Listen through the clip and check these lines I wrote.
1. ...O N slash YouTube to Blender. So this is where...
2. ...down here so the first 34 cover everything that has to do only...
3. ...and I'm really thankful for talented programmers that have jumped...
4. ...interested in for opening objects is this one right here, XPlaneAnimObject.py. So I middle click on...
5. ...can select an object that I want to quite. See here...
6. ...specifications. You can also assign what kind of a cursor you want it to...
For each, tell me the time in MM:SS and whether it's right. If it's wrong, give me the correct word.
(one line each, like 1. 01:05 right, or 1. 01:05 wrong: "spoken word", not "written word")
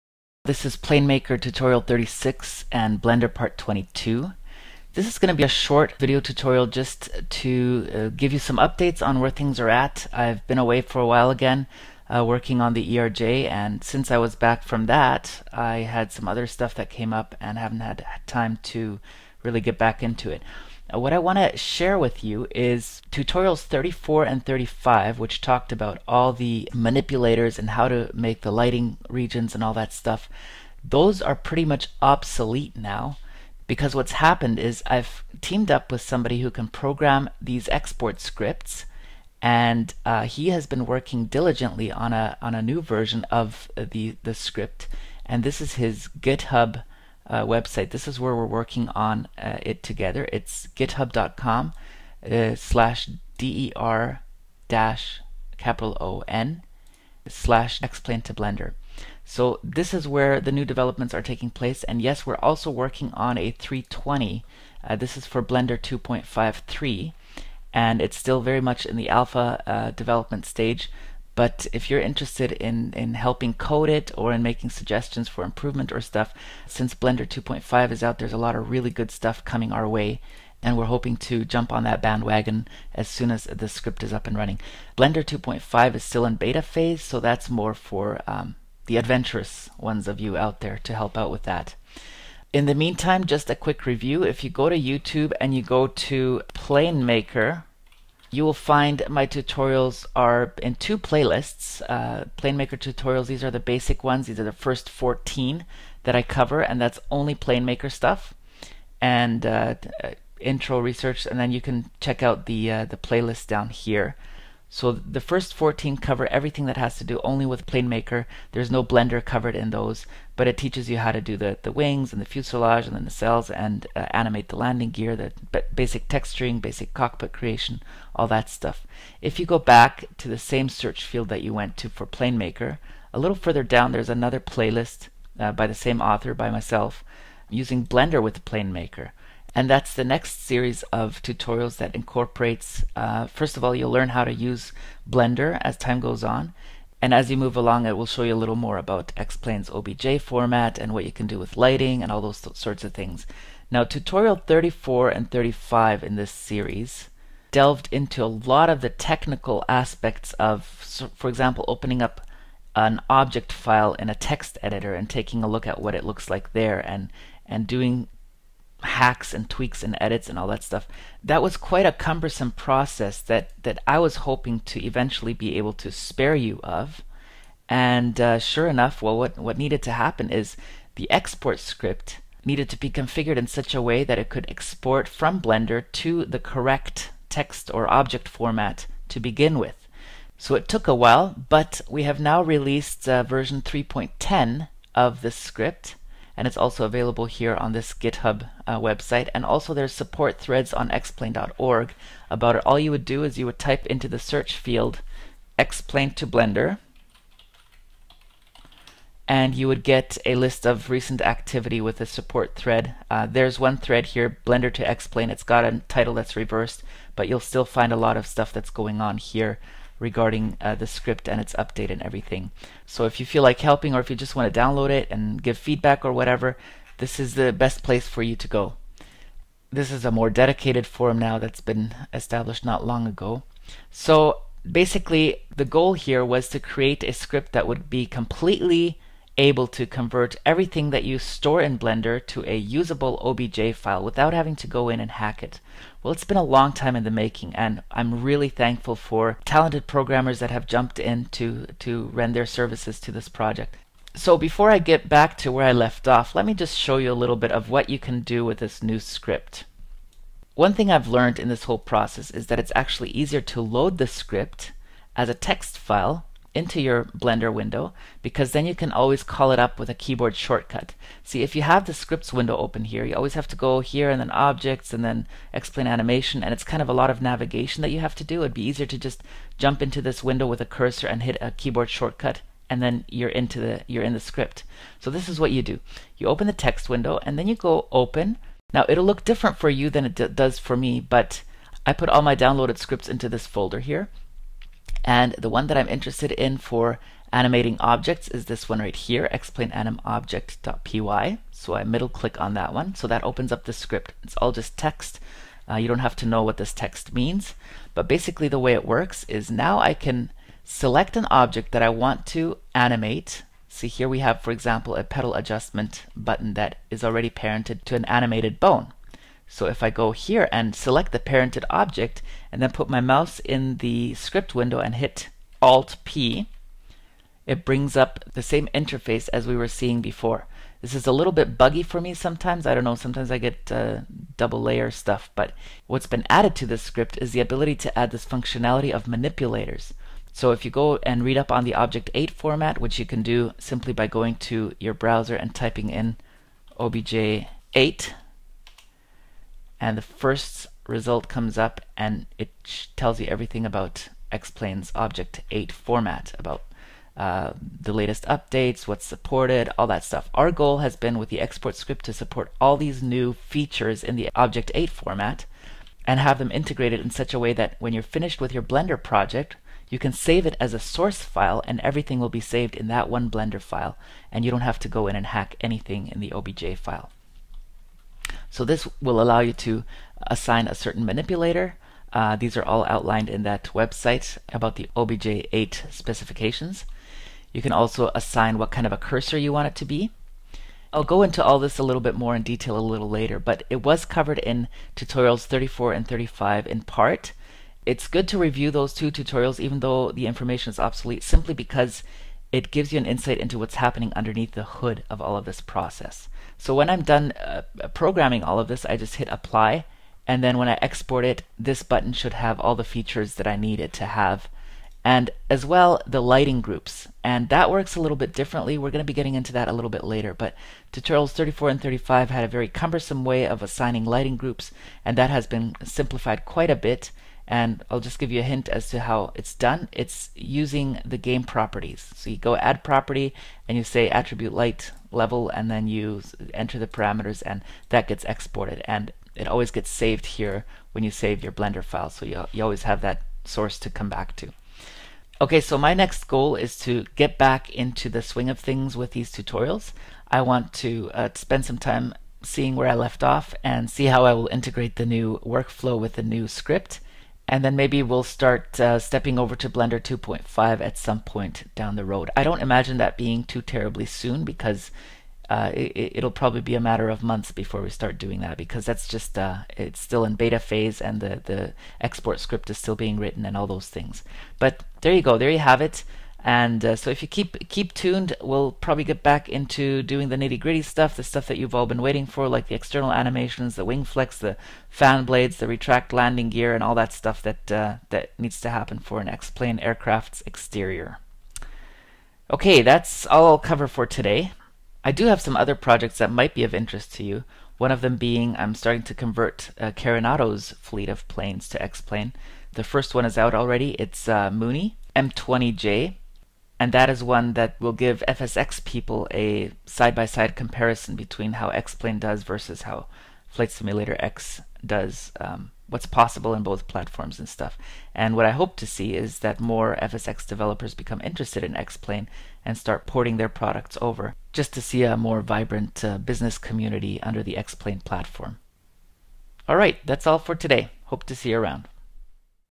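1. 00:56 wrong: "XPlane", not "YouTube"
2. 01:53 wrong: "14", not "34"
3. 04:07 right
4. 04:55 wrong: "animating", not "opening"
5. 05:09 wrong: "animate", not "quite"
6. 06:25 right.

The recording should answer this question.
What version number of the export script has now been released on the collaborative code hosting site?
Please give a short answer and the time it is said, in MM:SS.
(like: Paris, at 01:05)
3.10, at 03:13.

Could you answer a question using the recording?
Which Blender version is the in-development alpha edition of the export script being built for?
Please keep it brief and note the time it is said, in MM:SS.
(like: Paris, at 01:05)
2.53, at 01:05.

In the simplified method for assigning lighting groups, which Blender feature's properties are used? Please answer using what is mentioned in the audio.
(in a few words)
Game properties.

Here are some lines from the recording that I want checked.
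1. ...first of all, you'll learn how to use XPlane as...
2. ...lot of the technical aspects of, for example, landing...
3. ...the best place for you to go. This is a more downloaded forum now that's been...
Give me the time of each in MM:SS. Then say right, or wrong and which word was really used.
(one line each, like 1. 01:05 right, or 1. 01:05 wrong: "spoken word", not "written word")
1. 02:23 wrong: "Blender", not "XPlane"
2. 02:38 wrong: "opening", not "landing"
3. 03:47 wrong: "dedicated", not "downloaded".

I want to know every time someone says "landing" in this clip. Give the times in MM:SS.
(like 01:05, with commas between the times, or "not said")
02:04, 08:06.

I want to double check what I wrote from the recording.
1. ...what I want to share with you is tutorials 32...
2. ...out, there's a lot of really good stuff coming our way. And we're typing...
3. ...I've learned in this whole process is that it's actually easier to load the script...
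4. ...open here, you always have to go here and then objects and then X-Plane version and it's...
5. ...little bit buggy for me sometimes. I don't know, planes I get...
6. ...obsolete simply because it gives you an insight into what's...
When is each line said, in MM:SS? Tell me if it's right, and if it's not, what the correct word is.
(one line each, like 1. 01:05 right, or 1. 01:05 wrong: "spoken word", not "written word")
1. 00:20 wrong: "34", not "32"
2. 01:18 wrong: "hoping", not "typing"
3. 04:20 right
4. 04:32 wrong: "animation", not "version"
5. 05:31 wrong: "sometimes", not "planes"
6. 06:40 right.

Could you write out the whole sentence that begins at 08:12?
Okay, that's all I'll cover for today.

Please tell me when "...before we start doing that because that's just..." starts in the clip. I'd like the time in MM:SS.
07:47.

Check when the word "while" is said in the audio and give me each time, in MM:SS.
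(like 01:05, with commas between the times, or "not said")
00:11, 03:10.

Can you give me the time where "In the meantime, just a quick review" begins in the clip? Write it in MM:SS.
01:32.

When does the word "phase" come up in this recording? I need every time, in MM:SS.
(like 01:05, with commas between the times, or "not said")
01:26, 07:50.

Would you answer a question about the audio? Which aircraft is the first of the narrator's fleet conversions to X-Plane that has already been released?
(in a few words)
Mooney M20J.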